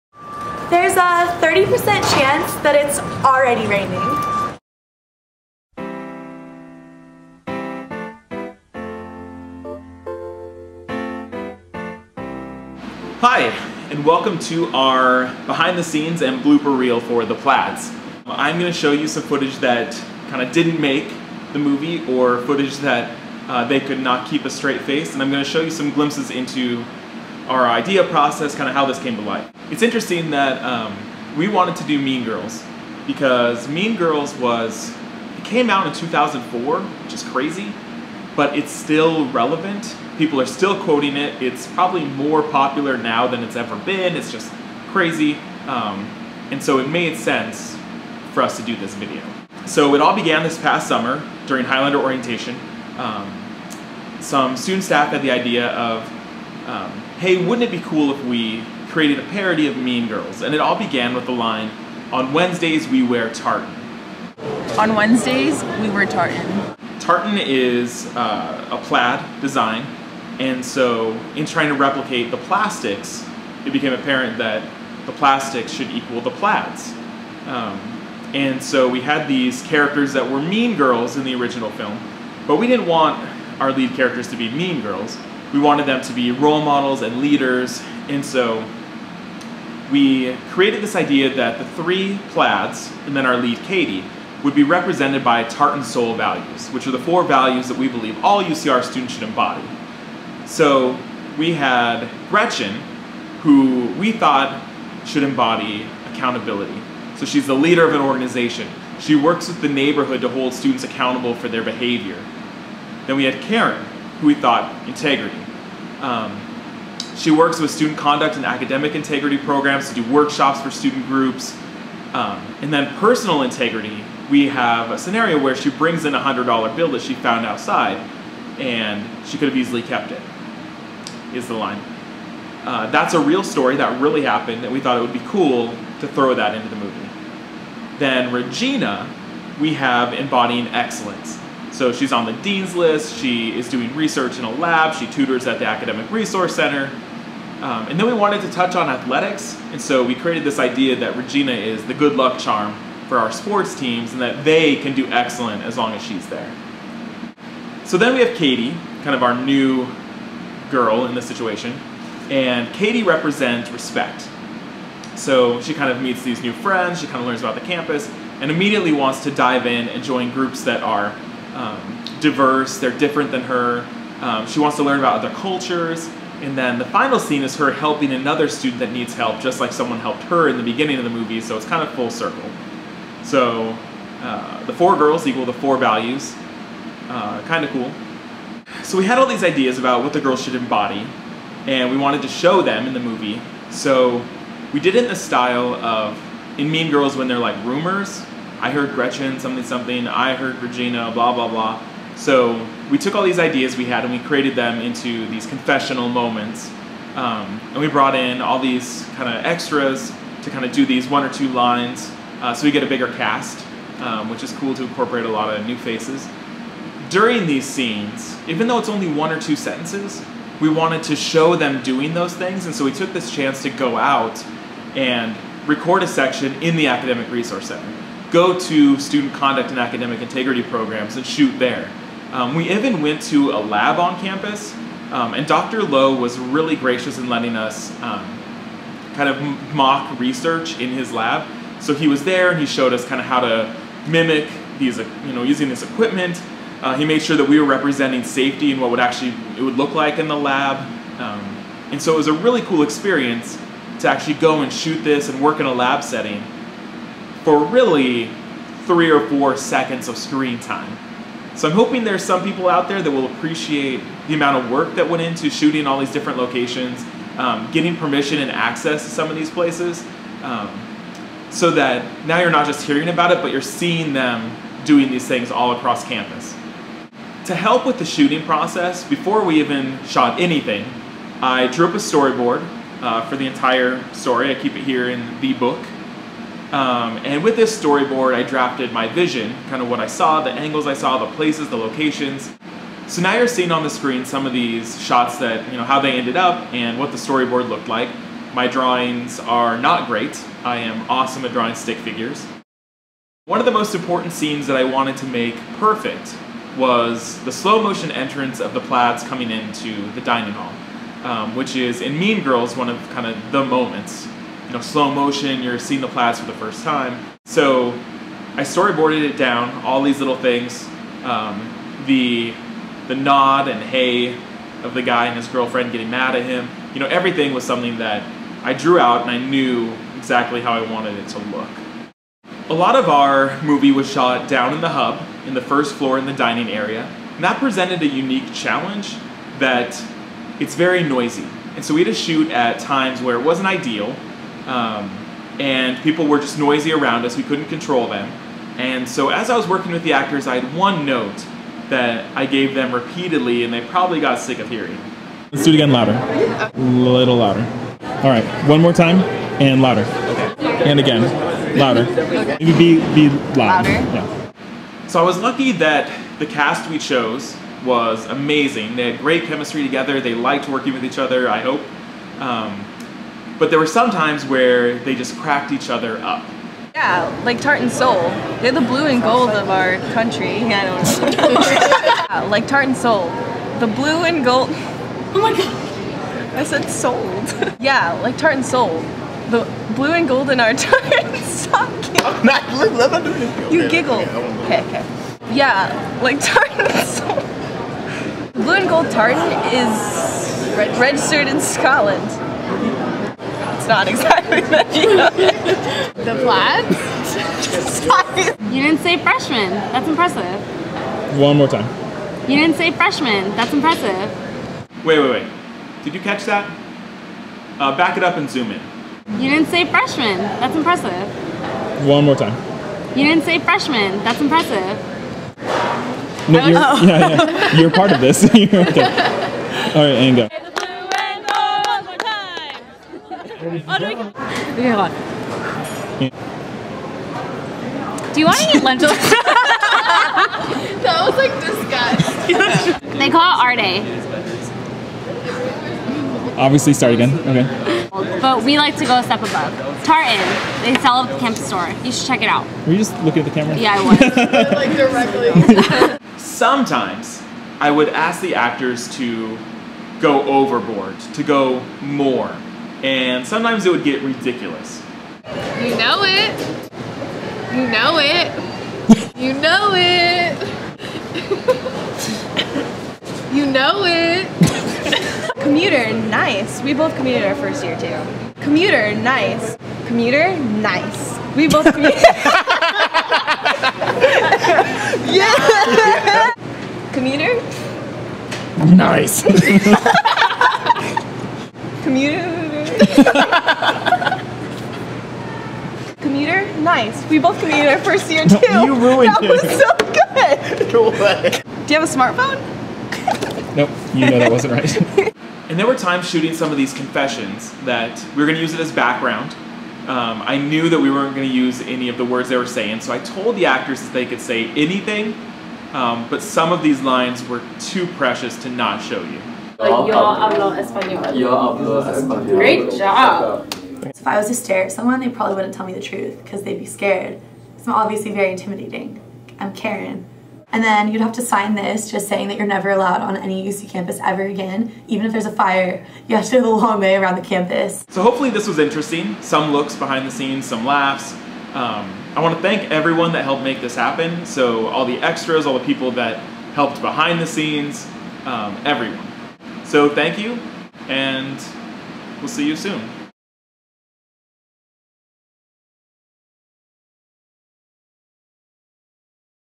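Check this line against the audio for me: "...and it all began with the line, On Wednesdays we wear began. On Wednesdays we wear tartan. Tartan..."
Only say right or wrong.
wrong.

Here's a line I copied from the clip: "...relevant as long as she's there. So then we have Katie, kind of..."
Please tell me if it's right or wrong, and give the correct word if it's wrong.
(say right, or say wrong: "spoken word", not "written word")
wrong: "excellent", not "relevant".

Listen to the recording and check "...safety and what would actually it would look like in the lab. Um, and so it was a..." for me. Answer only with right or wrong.
right.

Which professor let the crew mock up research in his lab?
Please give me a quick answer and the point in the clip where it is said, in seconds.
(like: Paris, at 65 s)
Dr. Lowe, at 235 s.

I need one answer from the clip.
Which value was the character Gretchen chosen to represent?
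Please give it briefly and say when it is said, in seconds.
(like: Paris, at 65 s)
accountability, at 106 s.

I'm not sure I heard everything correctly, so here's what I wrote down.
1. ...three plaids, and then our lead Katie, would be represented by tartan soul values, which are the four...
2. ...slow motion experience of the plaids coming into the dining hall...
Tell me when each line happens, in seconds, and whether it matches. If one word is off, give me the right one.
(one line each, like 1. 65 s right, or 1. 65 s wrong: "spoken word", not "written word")
1. 91 s right
2. 307 s wrong: "entrance", not "experience".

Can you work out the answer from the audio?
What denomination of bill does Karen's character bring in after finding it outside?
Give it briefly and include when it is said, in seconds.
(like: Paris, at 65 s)
$100, at 126 s.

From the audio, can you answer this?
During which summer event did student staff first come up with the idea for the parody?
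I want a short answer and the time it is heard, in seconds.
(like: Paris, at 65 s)
Highlander orientation, at 51 s.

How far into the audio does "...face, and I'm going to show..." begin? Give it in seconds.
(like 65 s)
24 s.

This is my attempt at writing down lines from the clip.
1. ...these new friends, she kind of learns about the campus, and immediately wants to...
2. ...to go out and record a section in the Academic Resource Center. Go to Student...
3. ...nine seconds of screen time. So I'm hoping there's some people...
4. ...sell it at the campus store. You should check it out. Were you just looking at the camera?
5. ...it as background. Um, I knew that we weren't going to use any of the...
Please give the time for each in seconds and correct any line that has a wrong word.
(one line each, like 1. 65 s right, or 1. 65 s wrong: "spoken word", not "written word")
1. 166 s right
2. 223 s right
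3. 259 s wrong: "four", not "nine"
4. 451 s right
5. 508 s right.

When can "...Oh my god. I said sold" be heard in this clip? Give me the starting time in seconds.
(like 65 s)
385 s.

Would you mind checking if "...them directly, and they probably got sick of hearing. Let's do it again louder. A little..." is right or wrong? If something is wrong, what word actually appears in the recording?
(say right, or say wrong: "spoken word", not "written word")
wrong: "repeatedly", not "directly".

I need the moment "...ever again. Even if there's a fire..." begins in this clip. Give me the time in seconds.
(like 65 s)
534 s.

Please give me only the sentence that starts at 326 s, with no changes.
You know, everything was something that I drew out and I knew exactly how I wanted it to look.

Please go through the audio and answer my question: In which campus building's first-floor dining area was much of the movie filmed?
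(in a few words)
the hub.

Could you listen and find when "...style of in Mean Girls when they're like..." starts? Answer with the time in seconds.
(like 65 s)
195 s.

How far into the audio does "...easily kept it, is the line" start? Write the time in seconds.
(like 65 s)
129 s.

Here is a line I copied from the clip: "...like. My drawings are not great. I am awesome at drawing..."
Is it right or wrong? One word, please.
right.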